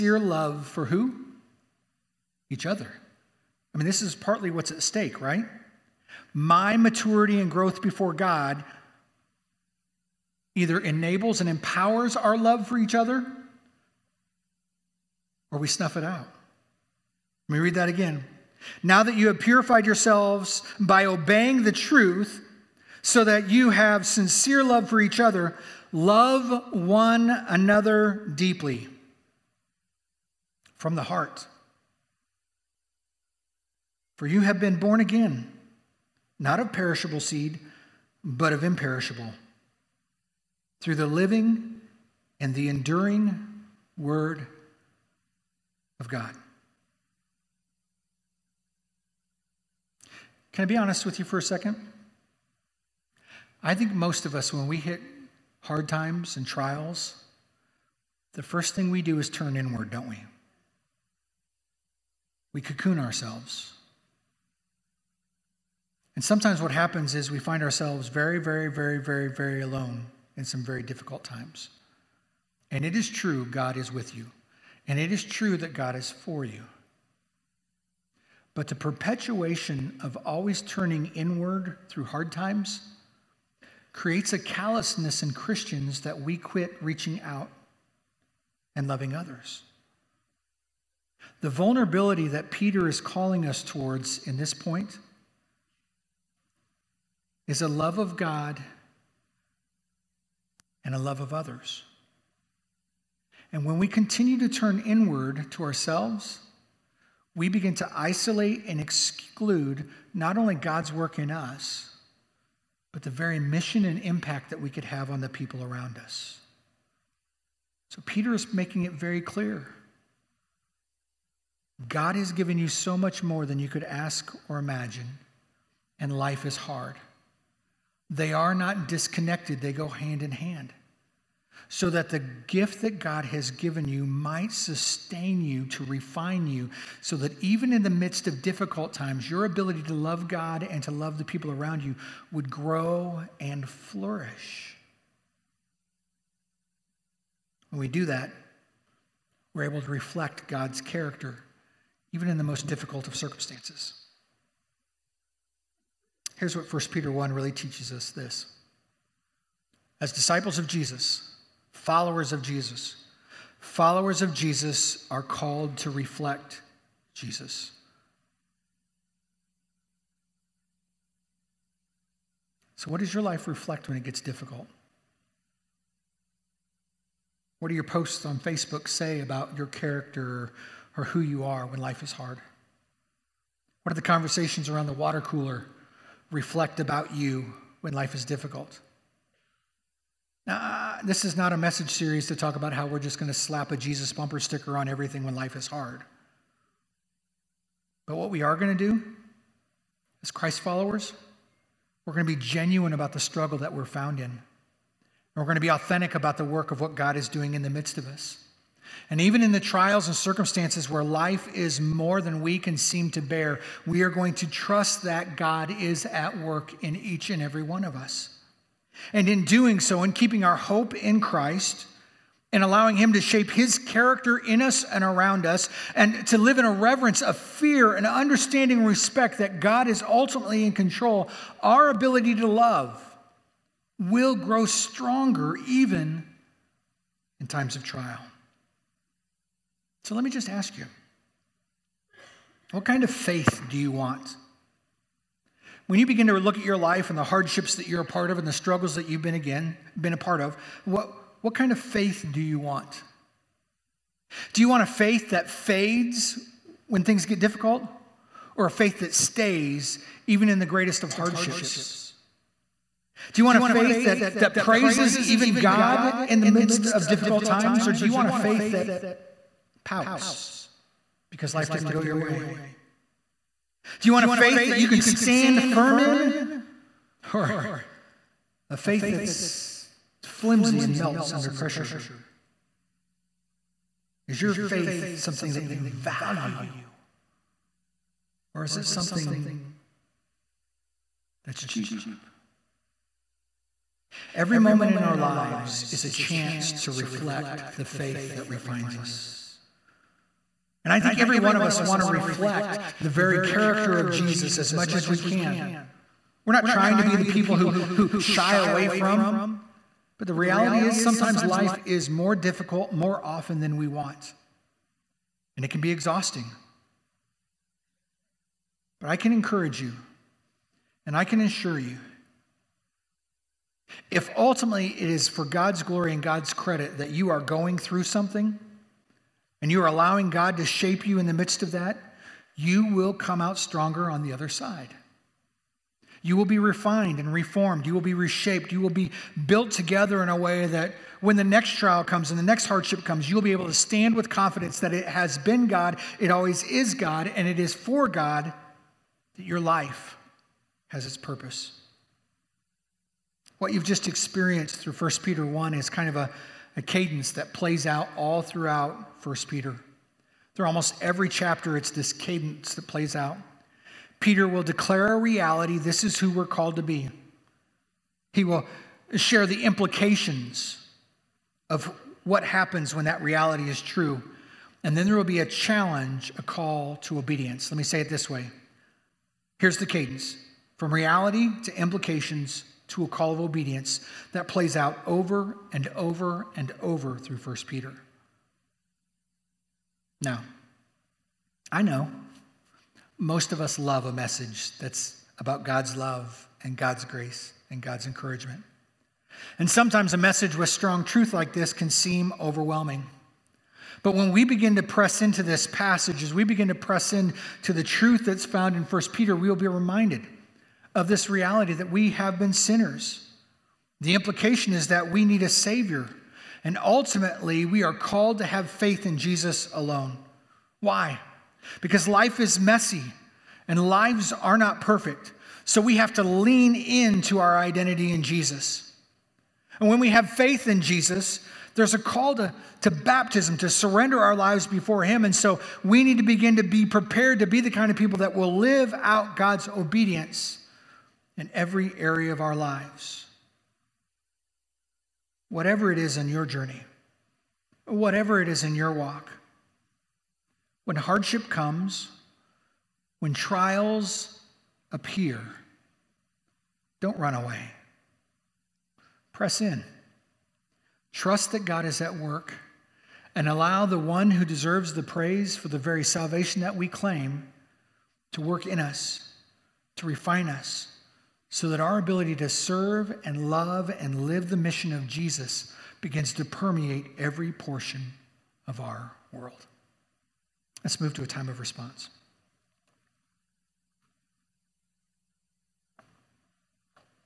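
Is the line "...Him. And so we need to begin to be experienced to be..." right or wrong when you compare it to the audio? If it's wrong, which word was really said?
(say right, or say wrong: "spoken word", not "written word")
wrong: "prepared", not "experienced".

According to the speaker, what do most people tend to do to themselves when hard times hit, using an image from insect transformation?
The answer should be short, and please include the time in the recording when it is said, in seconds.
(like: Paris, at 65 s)
cocoon ourselves, at 62 s.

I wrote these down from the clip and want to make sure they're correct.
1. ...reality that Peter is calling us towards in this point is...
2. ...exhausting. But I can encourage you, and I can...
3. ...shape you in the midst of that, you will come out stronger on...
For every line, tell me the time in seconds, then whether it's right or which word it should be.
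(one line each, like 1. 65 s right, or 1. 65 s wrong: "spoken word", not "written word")
1. 91 s wrong: "vulnerability", not "reality"
2. 315 s right
3. 330 s right.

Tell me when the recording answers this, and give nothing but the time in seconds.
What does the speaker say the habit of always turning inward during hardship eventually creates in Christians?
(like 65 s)
84 s.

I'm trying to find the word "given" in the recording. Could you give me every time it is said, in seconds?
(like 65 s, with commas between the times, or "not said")
122 s, 133 s.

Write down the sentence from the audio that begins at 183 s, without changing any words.
What do the conversations around the water cooler reflect about you when life is difficult?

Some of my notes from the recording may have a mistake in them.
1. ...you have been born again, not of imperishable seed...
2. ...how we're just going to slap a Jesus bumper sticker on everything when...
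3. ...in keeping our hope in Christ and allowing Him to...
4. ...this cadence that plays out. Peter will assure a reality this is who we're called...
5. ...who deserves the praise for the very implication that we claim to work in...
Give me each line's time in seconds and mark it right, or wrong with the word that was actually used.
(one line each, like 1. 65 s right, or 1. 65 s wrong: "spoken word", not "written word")
1. 34 s wrong: "perishable", not "imperishable"
2. 192 s right
3. 220 s right
4. 361 s wrong: "declare", not "assure"
5. 464 s wrong: "salvation", not "implication".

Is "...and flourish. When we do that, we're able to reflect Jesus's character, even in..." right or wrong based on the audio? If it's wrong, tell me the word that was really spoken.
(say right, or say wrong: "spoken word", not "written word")
wrong: "God", not "Jesus".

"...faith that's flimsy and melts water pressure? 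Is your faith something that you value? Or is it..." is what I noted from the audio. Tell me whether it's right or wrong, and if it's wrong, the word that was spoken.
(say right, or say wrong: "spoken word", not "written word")
wrong: "under", not "water".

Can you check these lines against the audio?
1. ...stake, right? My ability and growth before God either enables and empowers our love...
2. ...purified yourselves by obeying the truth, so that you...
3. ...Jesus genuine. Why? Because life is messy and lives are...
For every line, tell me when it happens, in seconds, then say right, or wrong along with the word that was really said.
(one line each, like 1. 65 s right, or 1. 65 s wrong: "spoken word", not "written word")
1. 4 s wrong: "maturity", not "ability"
2. 19 s right
3. 419 s wrong: "alone", not "genuine".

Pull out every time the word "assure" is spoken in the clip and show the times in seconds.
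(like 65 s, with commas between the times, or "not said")
321 s.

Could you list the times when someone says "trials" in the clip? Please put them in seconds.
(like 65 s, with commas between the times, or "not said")
56 s, 209 s, 237 s, 341 s, 453 s.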